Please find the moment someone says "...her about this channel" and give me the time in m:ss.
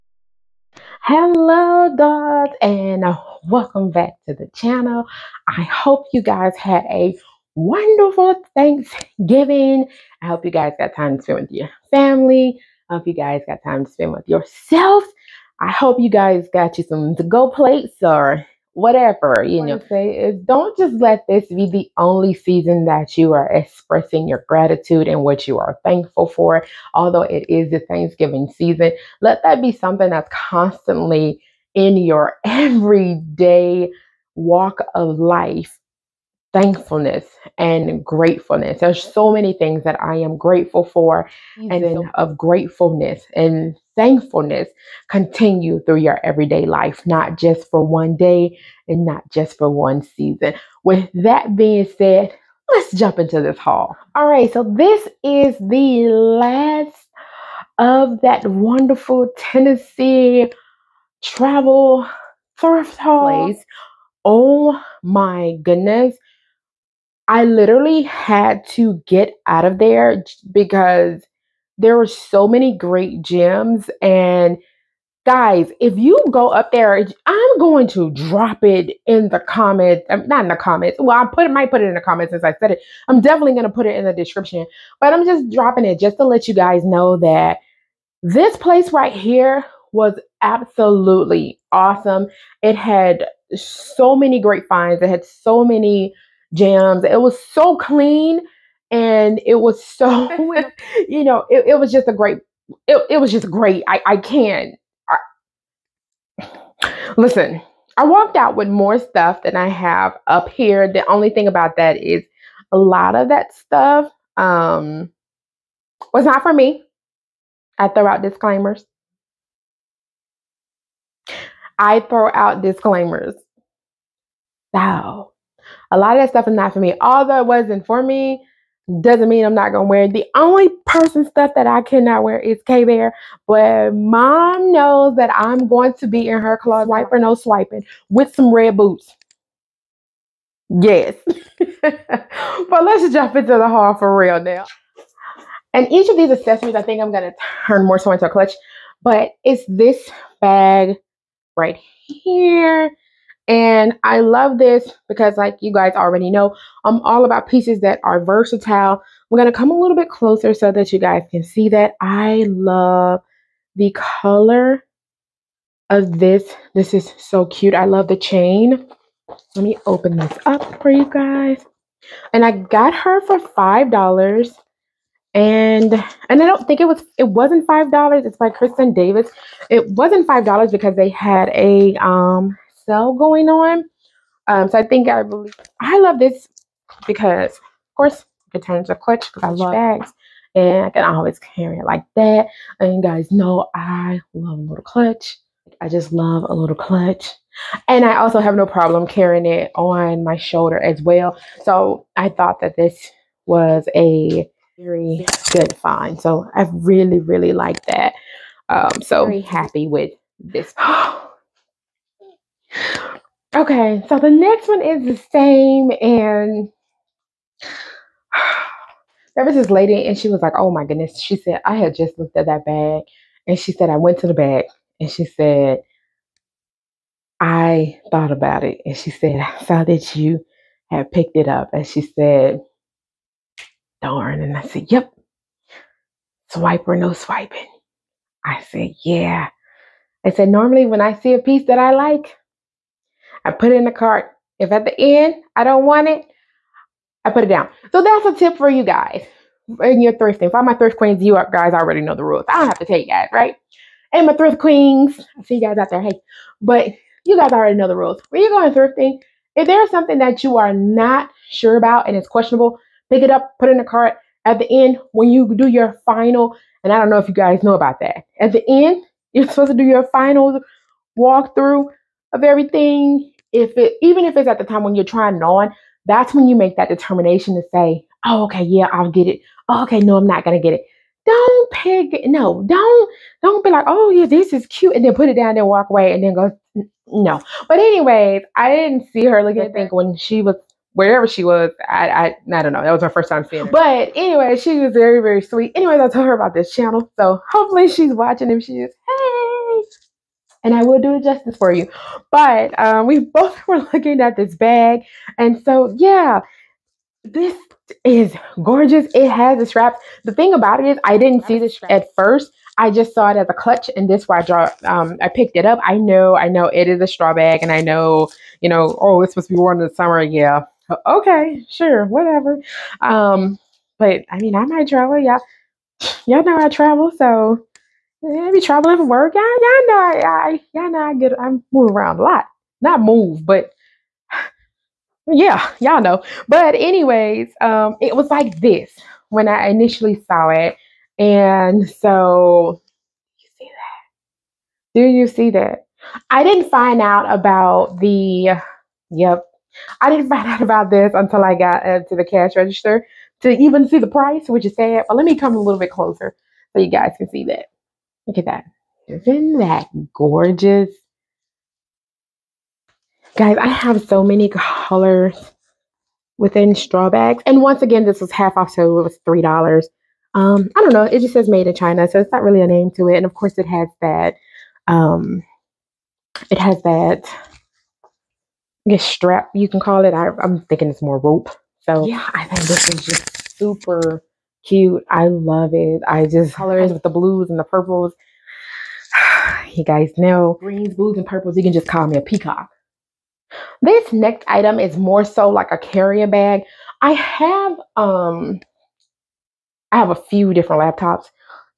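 4:56.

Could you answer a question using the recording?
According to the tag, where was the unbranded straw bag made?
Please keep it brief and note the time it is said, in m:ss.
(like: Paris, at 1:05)
China, at 6:11.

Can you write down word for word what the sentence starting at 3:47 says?
I thought about it and she said, I saw that you had picked it up.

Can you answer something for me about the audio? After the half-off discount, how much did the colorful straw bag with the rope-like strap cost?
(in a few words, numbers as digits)
$3.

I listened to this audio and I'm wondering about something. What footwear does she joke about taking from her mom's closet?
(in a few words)
red boots.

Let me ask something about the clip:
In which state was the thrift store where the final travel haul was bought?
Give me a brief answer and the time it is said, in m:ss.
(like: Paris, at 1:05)
Tennessee, at 0:59.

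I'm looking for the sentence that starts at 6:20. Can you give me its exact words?
I, am thinking it's more rope.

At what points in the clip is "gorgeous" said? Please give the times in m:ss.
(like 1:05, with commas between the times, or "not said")
5:08, 6:00.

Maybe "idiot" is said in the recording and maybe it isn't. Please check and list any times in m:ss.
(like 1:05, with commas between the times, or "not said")
not said.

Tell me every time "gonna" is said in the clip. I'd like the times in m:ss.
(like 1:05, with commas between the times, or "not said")
2:09, 2:27, 4:40.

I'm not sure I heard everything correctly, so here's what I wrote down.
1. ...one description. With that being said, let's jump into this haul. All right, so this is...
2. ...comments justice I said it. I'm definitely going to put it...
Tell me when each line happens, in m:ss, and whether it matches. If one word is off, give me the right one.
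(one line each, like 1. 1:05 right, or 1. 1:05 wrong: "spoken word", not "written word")
1. 0:49 wrong: "season", not "description"
2. 1:21 wrong: "since", not "justice".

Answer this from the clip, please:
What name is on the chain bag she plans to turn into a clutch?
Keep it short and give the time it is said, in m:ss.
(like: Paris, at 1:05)
Kristen Davis, at 2:58.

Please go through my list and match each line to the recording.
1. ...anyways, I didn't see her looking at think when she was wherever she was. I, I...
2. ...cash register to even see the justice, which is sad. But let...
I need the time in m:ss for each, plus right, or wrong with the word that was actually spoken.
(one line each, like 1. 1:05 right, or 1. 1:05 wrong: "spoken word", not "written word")
1. 4:47 right
2. 5:52 wrong: "price", not "justice".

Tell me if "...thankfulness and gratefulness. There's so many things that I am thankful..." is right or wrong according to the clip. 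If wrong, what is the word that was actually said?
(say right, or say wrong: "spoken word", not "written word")
wrong: "grateful", not "thankful".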